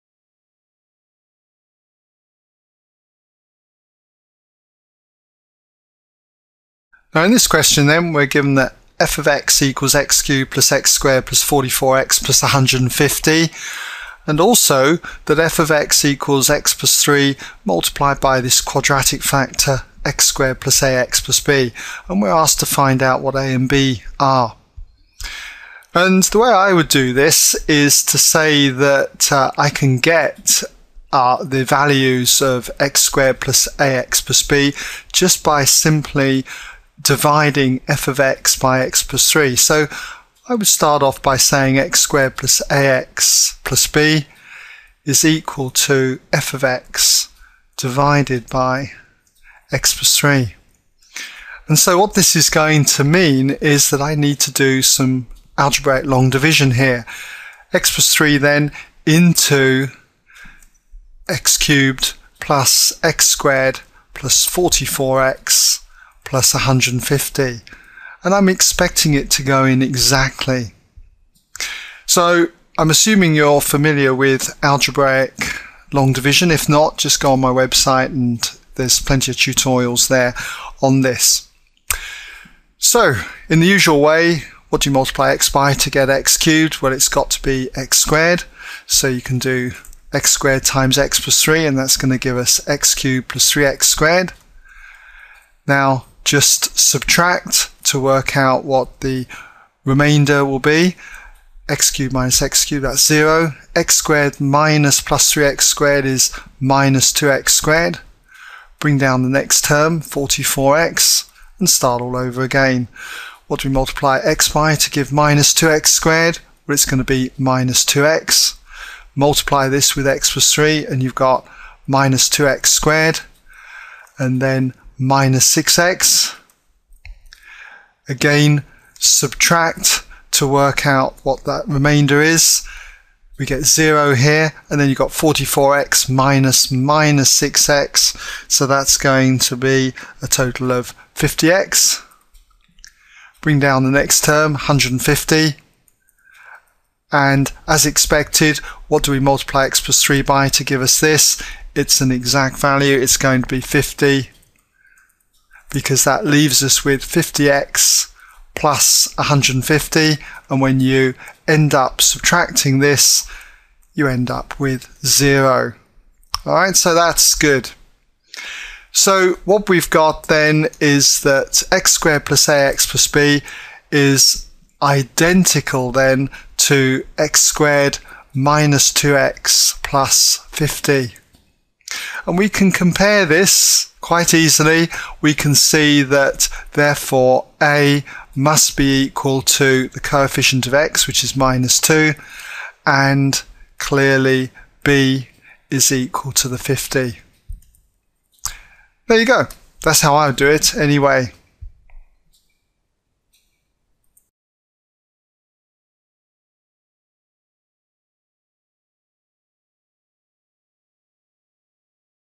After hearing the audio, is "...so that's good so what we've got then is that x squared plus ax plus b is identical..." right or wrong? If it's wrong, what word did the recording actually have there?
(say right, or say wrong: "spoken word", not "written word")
right.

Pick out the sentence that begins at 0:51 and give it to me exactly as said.
And so what this is going to mean is that I need to do some algebraic long division here.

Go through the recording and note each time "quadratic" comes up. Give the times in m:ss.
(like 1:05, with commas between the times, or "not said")
0:18.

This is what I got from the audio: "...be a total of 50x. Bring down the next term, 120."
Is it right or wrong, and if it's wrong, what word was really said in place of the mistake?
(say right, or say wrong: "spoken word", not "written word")
wrong: "150", not "120".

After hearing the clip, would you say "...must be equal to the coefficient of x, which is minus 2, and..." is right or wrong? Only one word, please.
right.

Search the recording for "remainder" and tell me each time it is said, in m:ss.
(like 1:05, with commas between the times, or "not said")
1:39, 2:11.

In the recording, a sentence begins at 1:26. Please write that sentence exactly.
Well, it's got to be x squared.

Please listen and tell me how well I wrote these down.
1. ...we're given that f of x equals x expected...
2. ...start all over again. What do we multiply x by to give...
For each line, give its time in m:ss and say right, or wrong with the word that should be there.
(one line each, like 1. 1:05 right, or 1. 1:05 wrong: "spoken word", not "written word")
1. 0:08 wrong: "cubed", not "expected"
2. 1:51 right.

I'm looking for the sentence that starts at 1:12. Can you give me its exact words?
So I'm assuming you're familiar with algebraic long division.